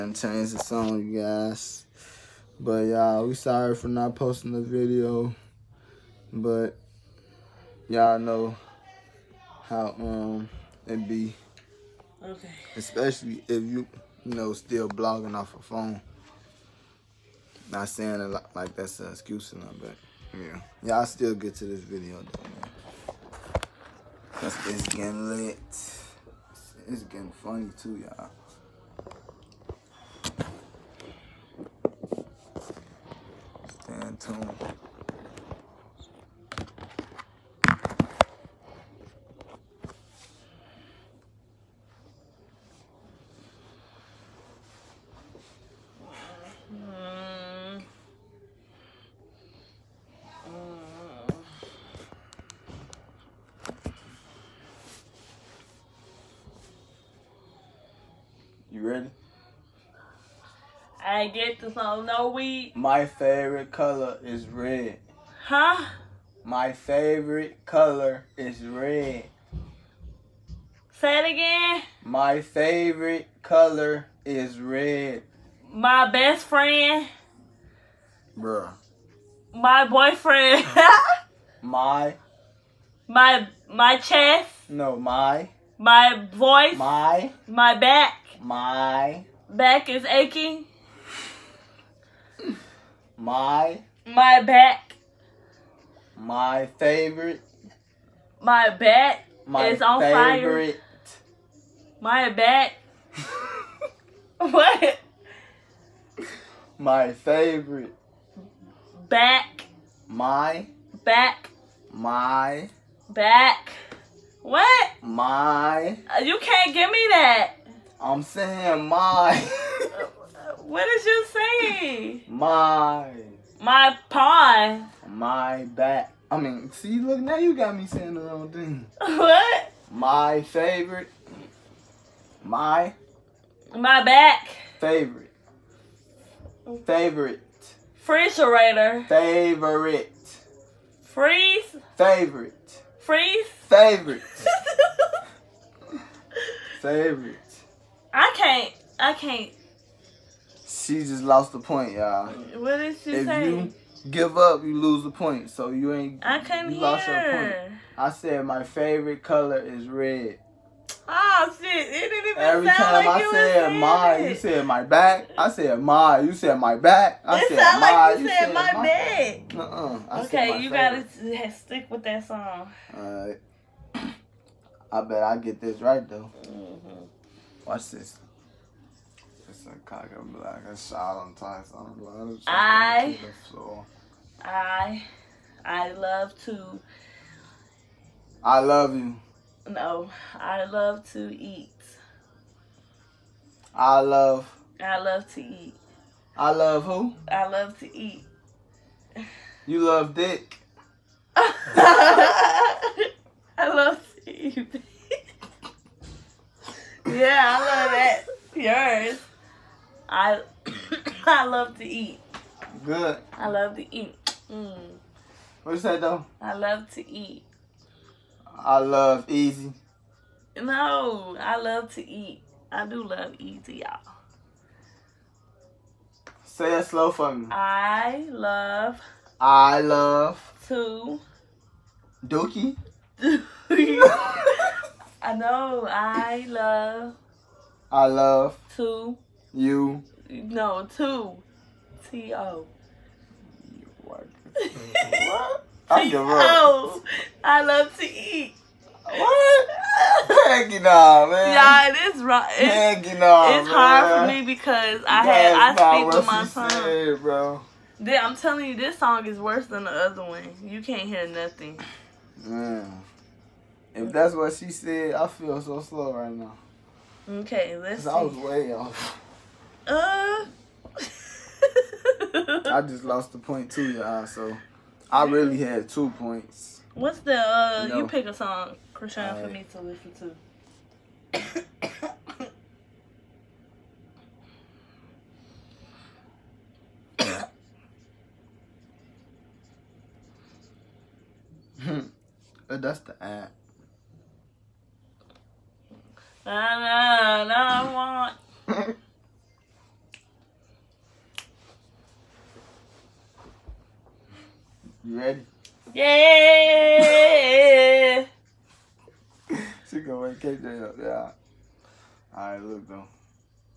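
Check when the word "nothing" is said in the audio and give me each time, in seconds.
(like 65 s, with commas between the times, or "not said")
19 s, 261 s.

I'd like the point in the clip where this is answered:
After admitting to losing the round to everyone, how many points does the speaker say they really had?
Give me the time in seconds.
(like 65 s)
275 s.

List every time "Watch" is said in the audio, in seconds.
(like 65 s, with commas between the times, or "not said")
177 s.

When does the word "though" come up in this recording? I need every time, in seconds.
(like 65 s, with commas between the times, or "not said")
22 s, 176 s, 216 s, 312 s.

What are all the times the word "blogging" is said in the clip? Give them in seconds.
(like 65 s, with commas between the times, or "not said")
14 s.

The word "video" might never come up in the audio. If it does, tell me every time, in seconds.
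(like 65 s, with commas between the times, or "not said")
4 s, 21 s.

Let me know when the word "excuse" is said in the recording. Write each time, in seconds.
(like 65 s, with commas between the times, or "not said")
19 s.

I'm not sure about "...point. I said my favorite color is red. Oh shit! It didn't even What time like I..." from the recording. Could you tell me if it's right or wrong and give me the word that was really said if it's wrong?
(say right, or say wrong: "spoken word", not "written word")
wrong: "Every", not "What".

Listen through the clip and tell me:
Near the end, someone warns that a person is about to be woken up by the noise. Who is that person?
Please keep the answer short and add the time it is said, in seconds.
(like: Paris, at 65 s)
KJ, at 310 s.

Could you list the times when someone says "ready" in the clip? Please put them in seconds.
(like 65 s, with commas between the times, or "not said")
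58 s, 305 s.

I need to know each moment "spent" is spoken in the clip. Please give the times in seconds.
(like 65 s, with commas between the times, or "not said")
not said.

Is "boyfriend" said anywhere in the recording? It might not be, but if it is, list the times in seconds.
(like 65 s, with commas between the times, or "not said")
79 s.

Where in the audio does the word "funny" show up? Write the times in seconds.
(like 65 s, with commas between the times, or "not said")
27 s.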